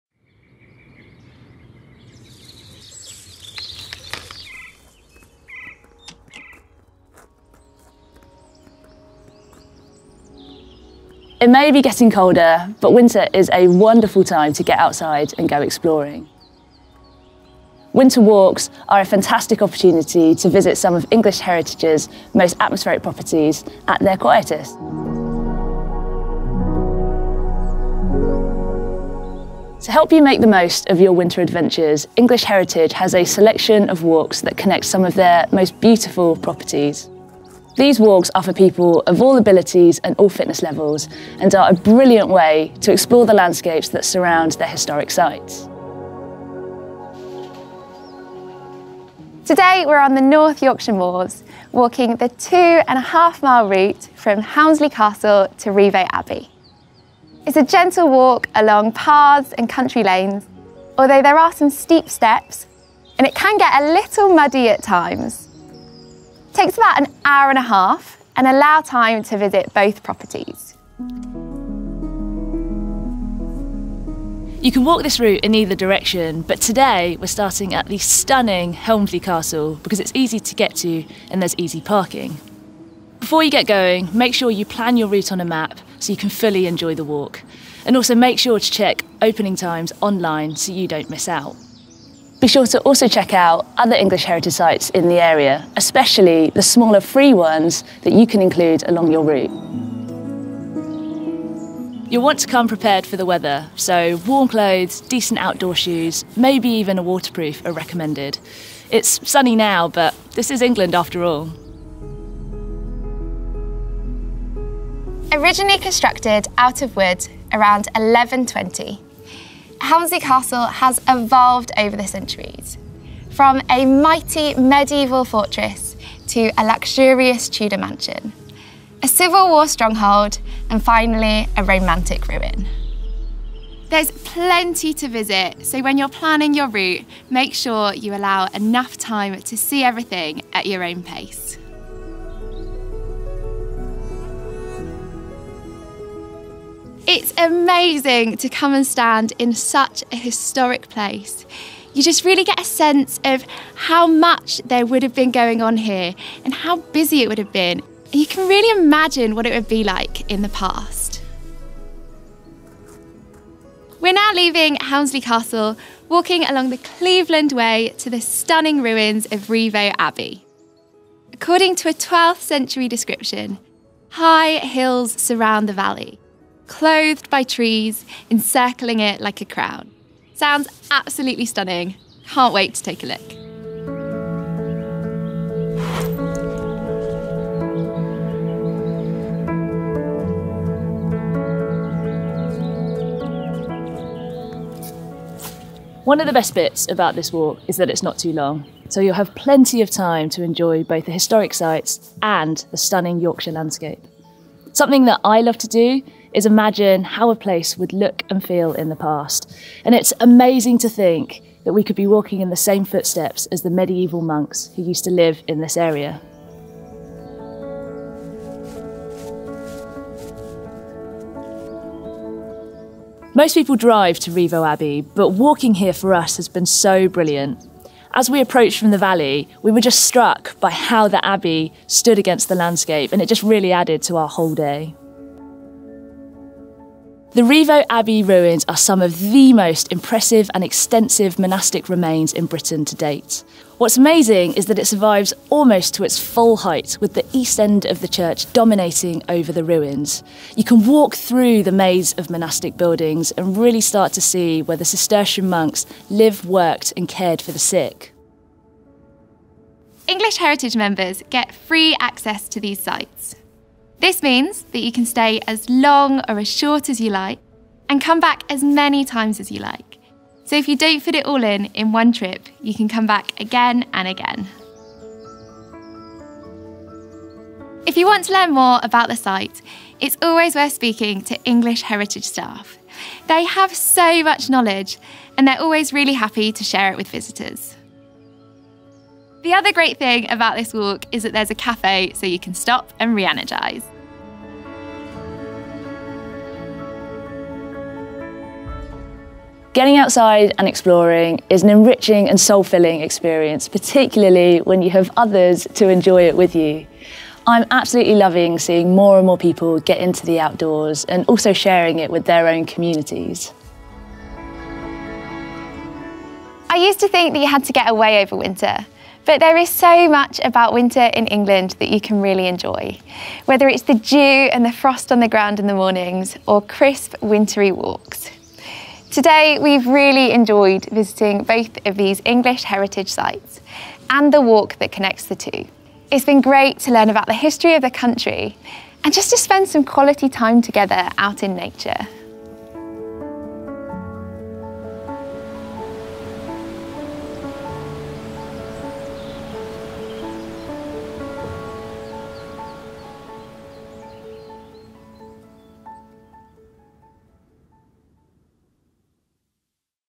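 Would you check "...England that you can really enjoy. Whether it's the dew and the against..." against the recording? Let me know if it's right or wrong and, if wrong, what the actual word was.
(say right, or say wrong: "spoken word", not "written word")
wrong: "frost", not "against".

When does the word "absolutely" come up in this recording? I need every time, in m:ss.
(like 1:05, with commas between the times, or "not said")
3:00, 5:07.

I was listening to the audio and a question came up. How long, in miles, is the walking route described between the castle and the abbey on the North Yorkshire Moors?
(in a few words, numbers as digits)
2.5 miles.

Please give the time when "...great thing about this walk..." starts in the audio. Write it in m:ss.
4:49.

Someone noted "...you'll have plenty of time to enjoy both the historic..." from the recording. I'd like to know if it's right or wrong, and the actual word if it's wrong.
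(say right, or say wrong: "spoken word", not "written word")
right.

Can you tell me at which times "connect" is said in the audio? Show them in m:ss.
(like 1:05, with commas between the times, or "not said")
0:34, 5:34.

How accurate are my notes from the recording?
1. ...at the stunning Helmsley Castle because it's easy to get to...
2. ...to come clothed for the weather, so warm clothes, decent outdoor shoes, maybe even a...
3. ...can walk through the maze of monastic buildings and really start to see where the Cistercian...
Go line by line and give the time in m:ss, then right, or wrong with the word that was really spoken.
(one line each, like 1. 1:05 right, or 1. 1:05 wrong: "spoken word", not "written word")
1. 1:17 right
2. 1:42 wrong: "prepared", not "clothed"
3. 4:10 right.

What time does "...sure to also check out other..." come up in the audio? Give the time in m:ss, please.
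1:32.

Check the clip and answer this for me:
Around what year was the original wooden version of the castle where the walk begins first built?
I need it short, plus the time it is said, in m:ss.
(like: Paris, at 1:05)
1120, at 1:57.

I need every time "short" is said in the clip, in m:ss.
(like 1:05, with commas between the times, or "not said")
4:26.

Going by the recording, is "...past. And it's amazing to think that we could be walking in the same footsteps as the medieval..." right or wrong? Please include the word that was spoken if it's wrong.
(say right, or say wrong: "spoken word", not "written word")
right.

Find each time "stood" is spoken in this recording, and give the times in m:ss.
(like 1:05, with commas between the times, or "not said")
3:51.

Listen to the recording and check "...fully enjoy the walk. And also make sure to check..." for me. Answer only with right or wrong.
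right.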